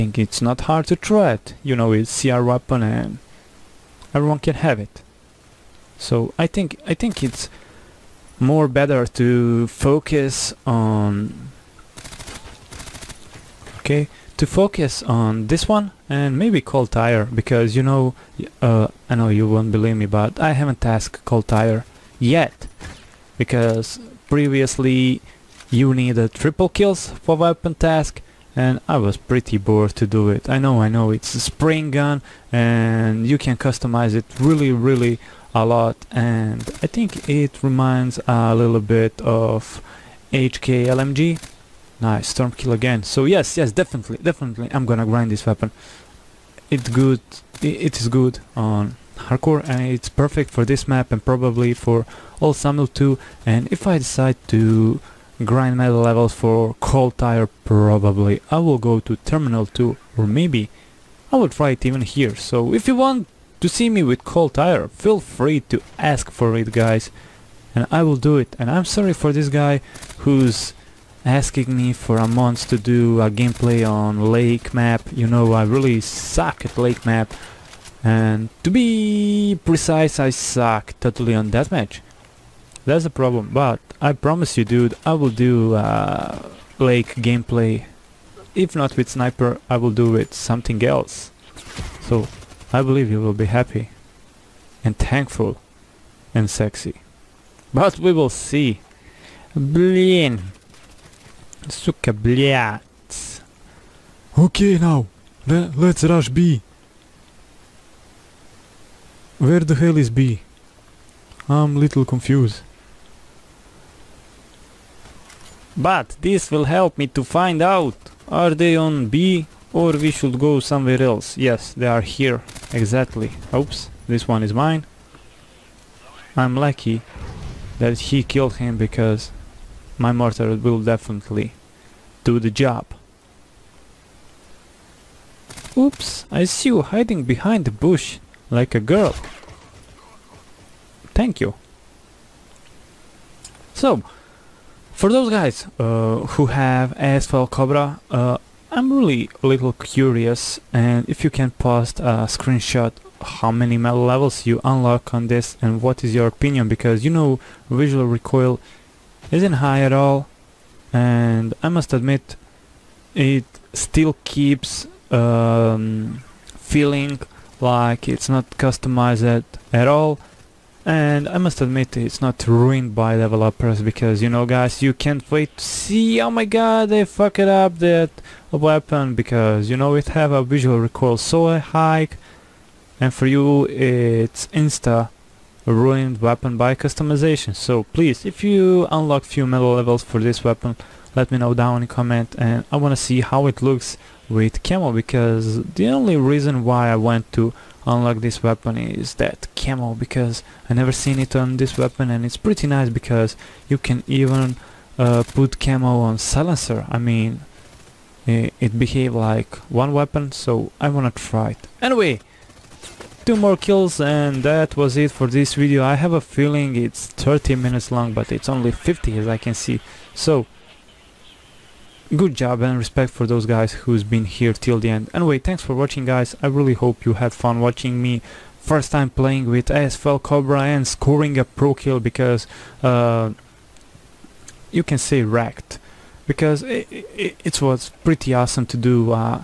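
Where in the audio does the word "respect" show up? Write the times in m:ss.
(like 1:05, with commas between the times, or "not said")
3:42.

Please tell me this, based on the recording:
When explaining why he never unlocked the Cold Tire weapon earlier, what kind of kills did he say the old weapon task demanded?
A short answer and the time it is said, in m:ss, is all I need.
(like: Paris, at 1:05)
triple kills, at 0:26.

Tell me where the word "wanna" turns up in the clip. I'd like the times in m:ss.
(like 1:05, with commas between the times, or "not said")
3:12, 3:30.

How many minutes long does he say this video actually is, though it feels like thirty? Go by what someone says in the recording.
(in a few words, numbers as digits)
50.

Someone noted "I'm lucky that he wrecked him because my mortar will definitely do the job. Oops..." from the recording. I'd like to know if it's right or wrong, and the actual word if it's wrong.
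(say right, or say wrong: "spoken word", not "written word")
wrong: "killed", not "wrecked".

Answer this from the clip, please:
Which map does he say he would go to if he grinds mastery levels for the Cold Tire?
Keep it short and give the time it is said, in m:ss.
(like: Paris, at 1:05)
Terminal 2, at 0:59.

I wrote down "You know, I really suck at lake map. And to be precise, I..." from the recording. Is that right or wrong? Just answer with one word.
right.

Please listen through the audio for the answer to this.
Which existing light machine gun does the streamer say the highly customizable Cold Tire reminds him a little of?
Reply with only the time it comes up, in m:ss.
0:40.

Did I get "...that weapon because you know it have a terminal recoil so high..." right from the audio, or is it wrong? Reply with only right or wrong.
wrong.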